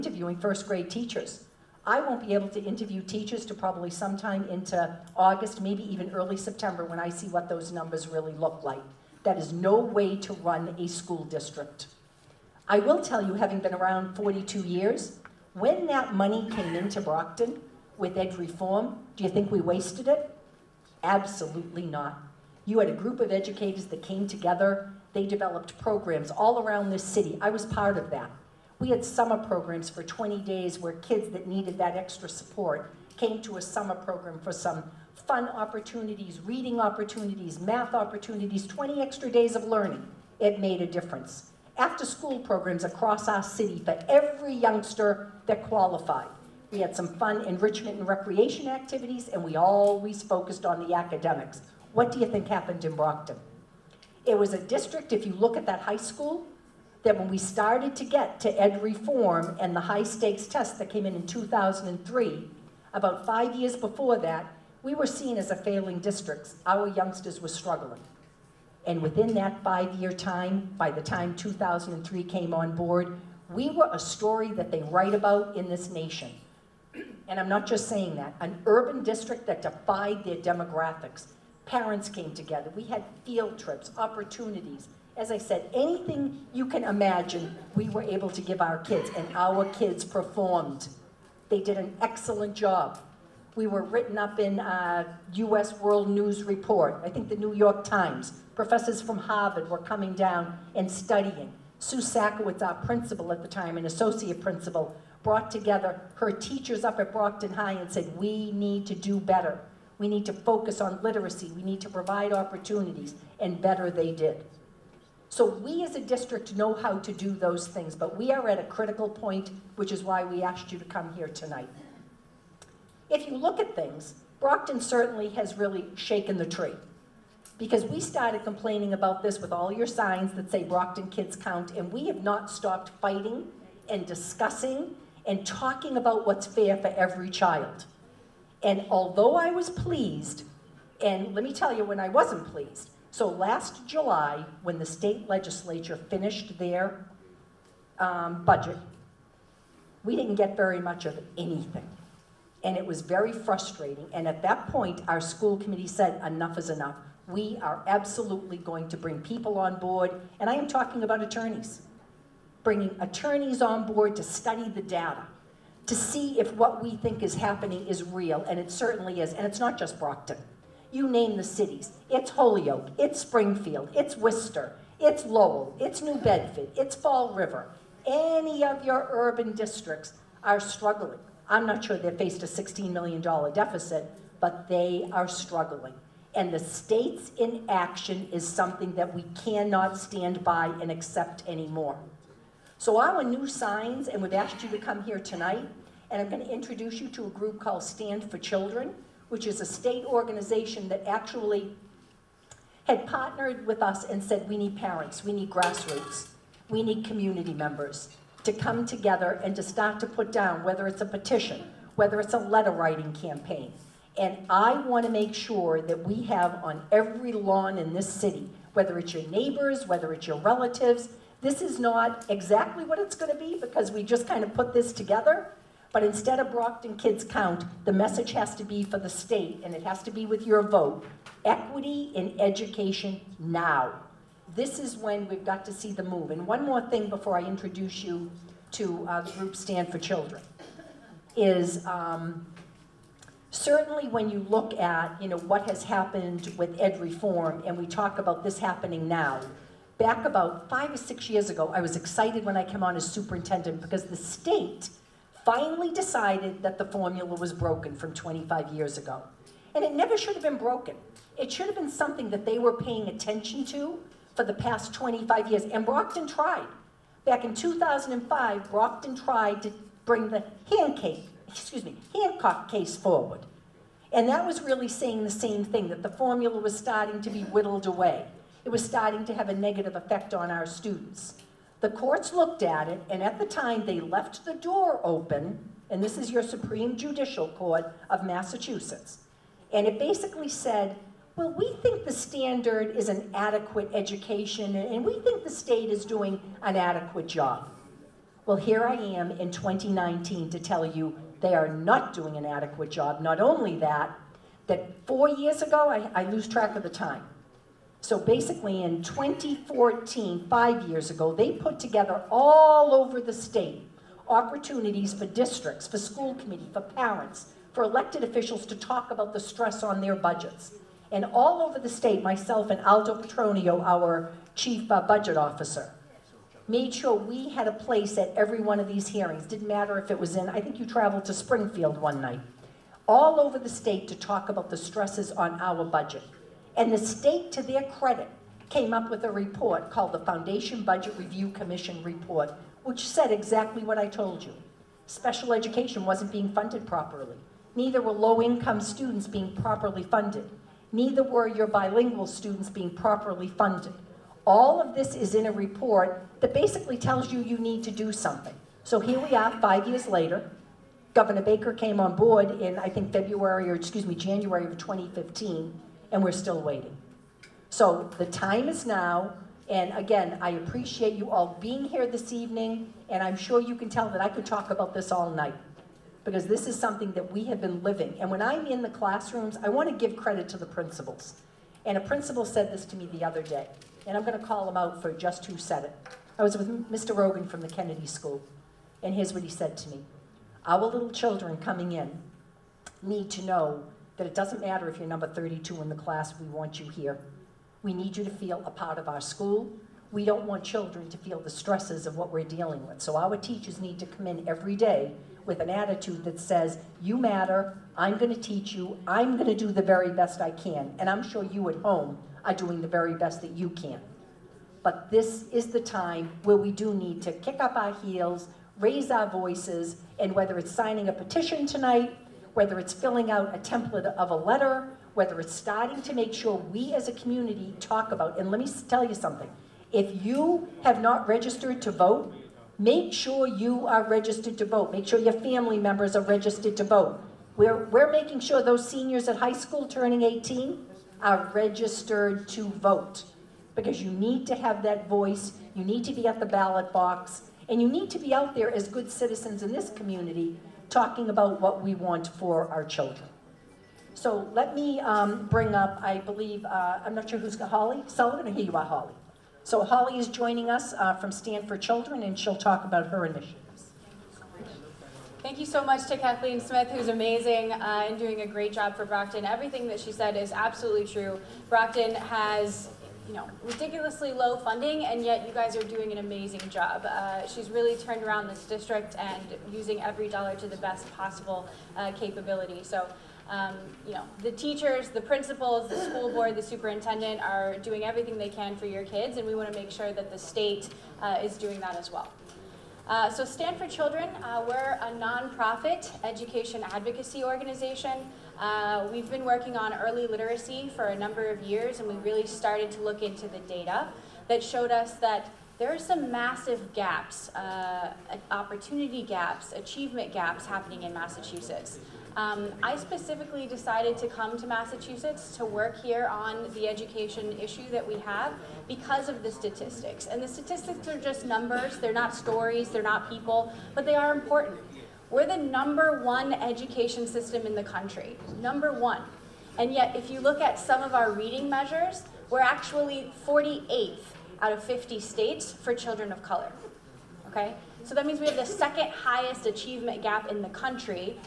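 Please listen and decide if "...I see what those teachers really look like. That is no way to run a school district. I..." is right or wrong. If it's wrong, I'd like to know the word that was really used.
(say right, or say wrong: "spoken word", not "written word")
wrong: "numbers", not "teachers".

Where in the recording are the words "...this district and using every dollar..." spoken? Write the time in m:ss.
7:58.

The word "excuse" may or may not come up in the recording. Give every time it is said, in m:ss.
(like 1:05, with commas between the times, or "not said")
4:31, 6:03.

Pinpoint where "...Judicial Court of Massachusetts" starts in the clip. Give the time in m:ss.
4:46.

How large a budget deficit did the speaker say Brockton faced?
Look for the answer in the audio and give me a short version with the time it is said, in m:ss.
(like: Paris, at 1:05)
$16 million, at 3:02.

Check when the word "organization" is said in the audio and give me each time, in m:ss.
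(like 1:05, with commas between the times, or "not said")
3:20, 8:17.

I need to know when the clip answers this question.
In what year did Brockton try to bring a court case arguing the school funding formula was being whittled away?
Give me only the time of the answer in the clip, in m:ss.
4:27.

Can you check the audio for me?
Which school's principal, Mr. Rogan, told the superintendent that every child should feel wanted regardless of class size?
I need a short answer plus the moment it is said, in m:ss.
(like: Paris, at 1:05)
Kennedy School, at 6:27.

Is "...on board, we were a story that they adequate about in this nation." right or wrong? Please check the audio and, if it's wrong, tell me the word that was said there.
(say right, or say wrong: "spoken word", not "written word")
wrong: "write", not "adequate".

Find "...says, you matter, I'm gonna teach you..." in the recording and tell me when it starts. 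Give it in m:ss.
6:46.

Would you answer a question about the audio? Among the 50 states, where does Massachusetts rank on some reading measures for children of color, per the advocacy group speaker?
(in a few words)
48th.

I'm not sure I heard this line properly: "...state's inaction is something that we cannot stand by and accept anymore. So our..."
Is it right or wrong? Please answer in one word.
right.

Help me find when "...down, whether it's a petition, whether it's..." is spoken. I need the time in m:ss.
3:30.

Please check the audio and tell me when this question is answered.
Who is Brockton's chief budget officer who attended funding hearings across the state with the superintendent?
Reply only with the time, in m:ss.
5:22.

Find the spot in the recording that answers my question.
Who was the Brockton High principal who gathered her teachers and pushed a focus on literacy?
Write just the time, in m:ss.
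1:41.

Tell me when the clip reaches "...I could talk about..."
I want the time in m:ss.
6:14.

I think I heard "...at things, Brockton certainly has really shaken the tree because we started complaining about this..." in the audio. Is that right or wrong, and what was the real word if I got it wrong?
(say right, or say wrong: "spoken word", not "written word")
right.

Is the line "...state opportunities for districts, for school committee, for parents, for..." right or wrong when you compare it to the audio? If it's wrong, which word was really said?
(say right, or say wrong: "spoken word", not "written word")
right.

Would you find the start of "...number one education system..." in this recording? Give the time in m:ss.
8:45.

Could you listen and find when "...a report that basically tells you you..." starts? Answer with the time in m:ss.
5:55.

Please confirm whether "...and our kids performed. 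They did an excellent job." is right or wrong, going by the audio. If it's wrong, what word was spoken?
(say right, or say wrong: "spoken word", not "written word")
right.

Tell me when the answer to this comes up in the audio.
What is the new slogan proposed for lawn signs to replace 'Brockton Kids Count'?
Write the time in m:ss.
3:51.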